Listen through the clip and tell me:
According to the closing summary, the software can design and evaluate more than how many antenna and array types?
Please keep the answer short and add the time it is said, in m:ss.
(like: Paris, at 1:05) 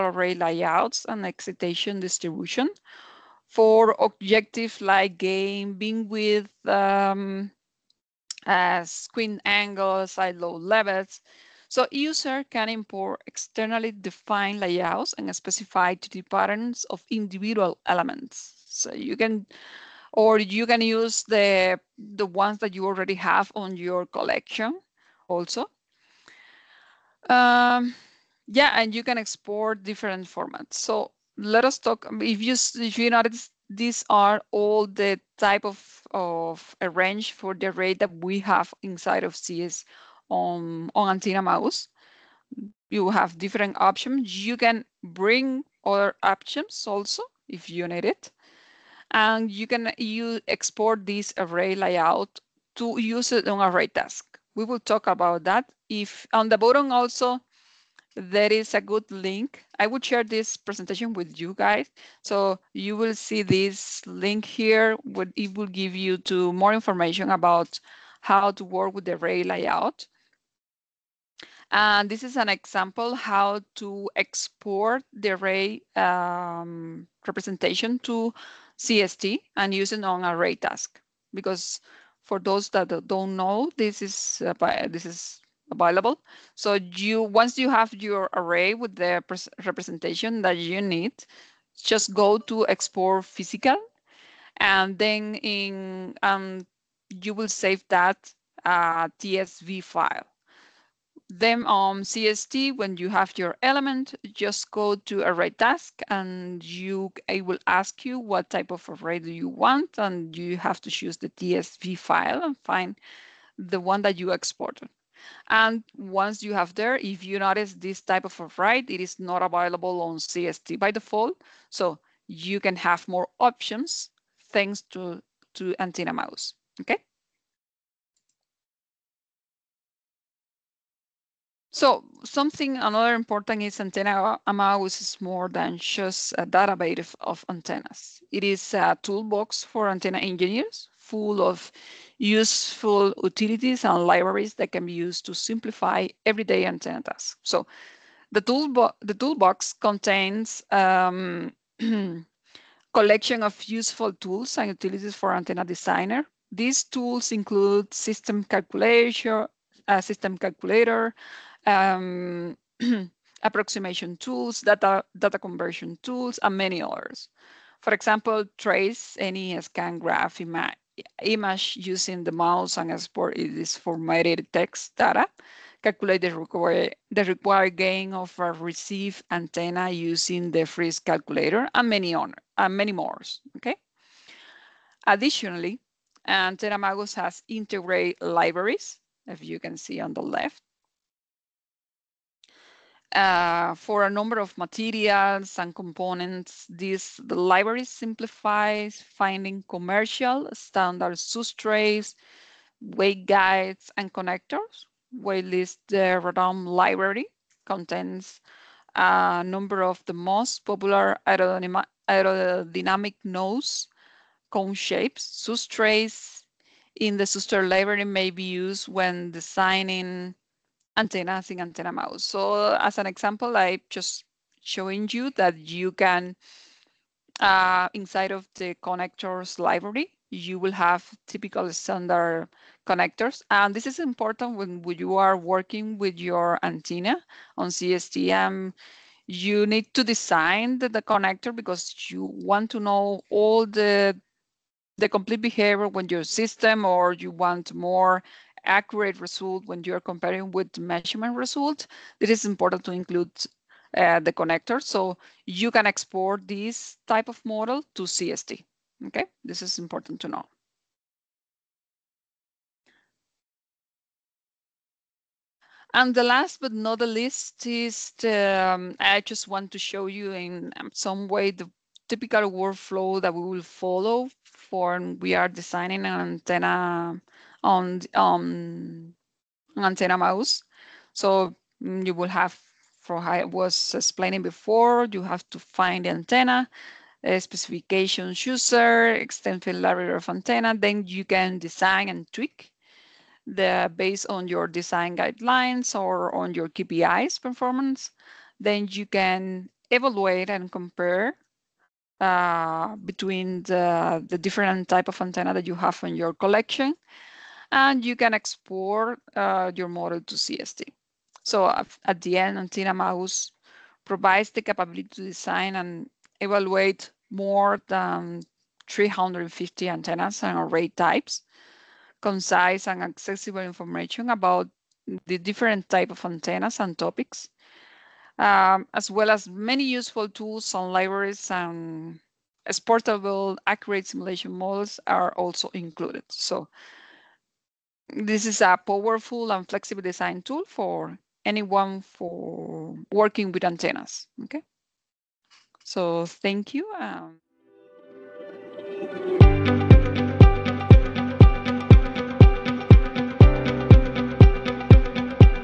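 350, at 5:18.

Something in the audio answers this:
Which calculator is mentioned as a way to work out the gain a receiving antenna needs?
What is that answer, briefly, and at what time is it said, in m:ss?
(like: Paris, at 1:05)
Friis calculator, at 3:00.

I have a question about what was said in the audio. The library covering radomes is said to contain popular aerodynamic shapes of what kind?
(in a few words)
nose cone.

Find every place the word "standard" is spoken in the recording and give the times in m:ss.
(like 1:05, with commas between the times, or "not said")
3:20, 3:51.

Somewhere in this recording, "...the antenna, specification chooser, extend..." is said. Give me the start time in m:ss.
4:46.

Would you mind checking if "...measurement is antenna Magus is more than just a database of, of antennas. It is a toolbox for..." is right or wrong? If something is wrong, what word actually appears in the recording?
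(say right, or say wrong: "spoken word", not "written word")
wrong: "important", not "measurement".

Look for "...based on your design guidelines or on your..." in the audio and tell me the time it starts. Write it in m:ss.
4:53.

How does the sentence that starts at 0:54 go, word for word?
We will talk about that if on the bottom also, there is a good link.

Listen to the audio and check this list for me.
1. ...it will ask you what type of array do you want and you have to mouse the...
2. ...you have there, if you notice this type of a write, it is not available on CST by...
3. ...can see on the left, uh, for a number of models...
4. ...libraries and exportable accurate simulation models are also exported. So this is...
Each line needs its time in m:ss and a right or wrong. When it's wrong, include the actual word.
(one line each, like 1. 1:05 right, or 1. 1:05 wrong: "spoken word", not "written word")
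1. 1:47 wrong: "choose", not "mouse"
2. 1:56 right
3. 3:09 wrong: "materials", not "models"
4. 5:30 wrong: "included", not "exported".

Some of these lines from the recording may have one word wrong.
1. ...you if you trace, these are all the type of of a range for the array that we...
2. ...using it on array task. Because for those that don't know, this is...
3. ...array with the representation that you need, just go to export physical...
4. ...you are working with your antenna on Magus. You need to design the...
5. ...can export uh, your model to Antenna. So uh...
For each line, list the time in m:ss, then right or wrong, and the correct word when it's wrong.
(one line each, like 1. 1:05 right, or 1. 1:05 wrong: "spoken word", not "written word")
1. 0:32 wrong: "notice", not "trace"
2. 1:19 right
3. 1:28 right
4. 3:54 wrong: "CSTM", not "Magus"
5. 5:08 wrong: "CST", not "Antenna".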